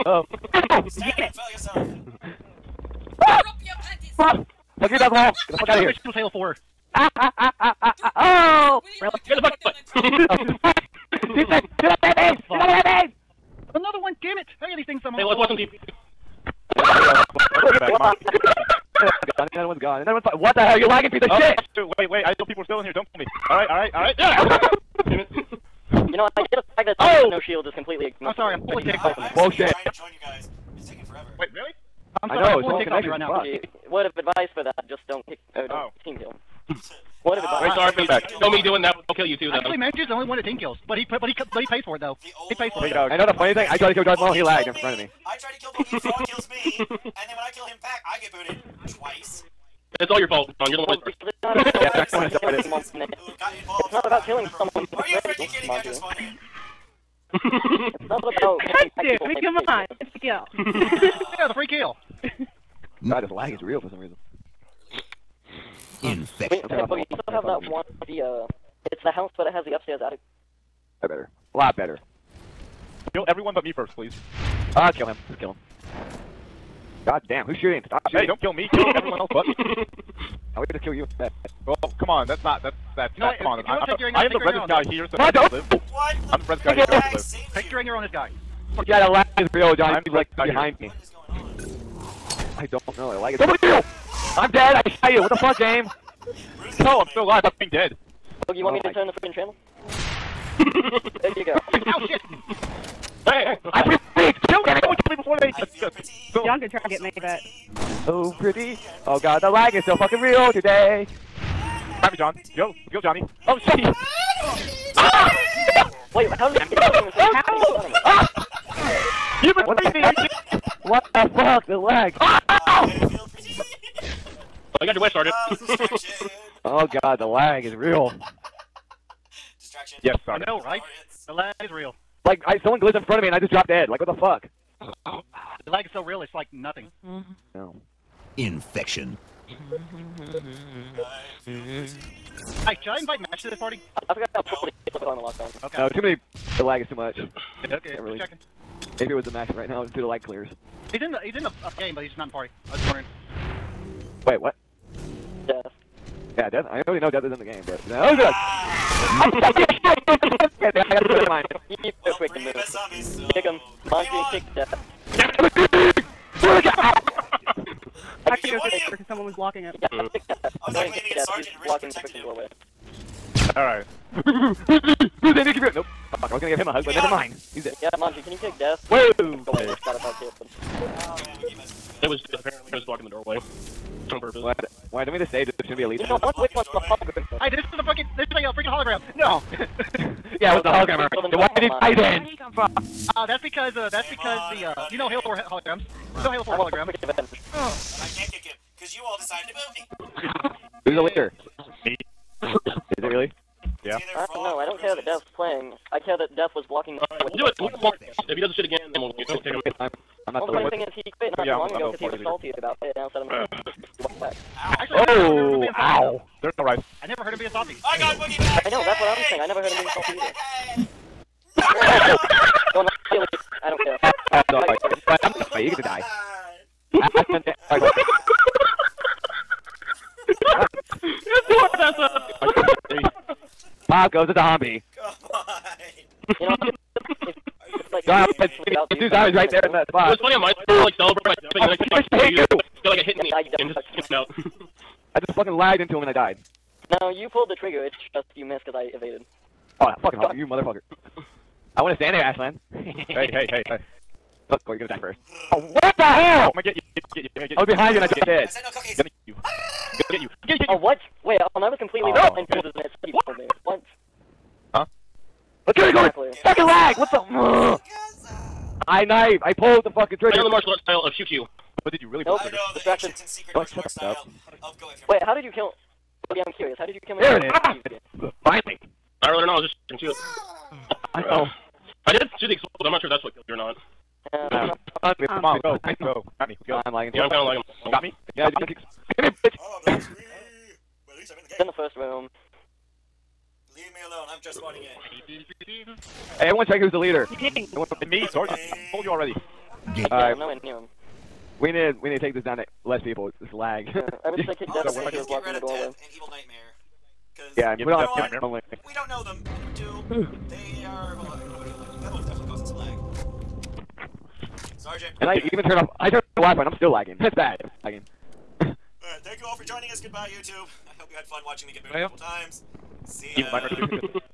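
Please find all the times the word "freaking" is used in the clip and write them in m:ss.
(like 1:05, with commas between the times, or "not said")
0:55, 1:39, 2:51, 3:08.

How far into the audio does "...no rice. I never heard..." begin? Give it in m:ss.
3:36.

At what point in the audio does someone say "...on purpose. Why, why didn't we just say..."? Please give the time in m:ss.
3:04.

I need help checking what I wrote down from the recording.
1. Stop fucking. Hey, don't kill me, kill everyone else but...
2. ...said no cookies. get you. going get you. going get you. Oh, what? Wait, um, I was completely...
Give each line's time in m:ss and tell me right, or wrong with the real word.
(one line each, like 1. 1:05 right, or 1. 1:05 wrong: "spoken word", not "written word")
1. 1:17 wrong: "shooting", not "fucking"
2. 4:18 right.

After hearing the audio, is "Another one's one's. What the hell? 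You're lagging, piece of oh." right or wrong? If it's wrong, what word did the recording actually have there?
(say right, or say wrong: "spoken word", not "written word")
right.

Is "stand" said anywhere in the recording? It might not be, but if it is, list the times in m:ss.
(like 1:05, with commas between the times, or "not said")
4:11.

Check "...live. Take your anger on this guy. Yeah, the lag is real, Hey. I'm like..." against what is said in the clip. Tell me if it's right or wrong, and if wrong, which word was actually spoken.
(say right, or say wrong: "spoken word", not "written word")
wrong: "John", not "Hey".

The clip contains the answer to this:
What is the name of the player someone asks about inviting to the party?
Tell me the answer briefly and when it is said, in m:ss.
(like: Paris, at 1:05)
Match, at 2:23.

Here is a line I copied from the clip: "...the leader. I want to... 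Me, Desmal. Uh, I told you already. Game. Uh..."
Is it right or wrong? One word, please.
wrong.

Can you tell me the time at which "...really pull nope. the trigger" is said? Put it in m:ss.
4:32.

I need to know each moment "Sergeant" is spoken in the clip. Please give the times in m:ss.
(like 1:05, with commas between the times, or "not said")
2:05, 2:51, 4:58, 5:14.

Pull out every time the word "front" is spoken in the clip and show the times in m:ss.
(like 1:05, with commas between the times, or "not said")
0:44, 2:13.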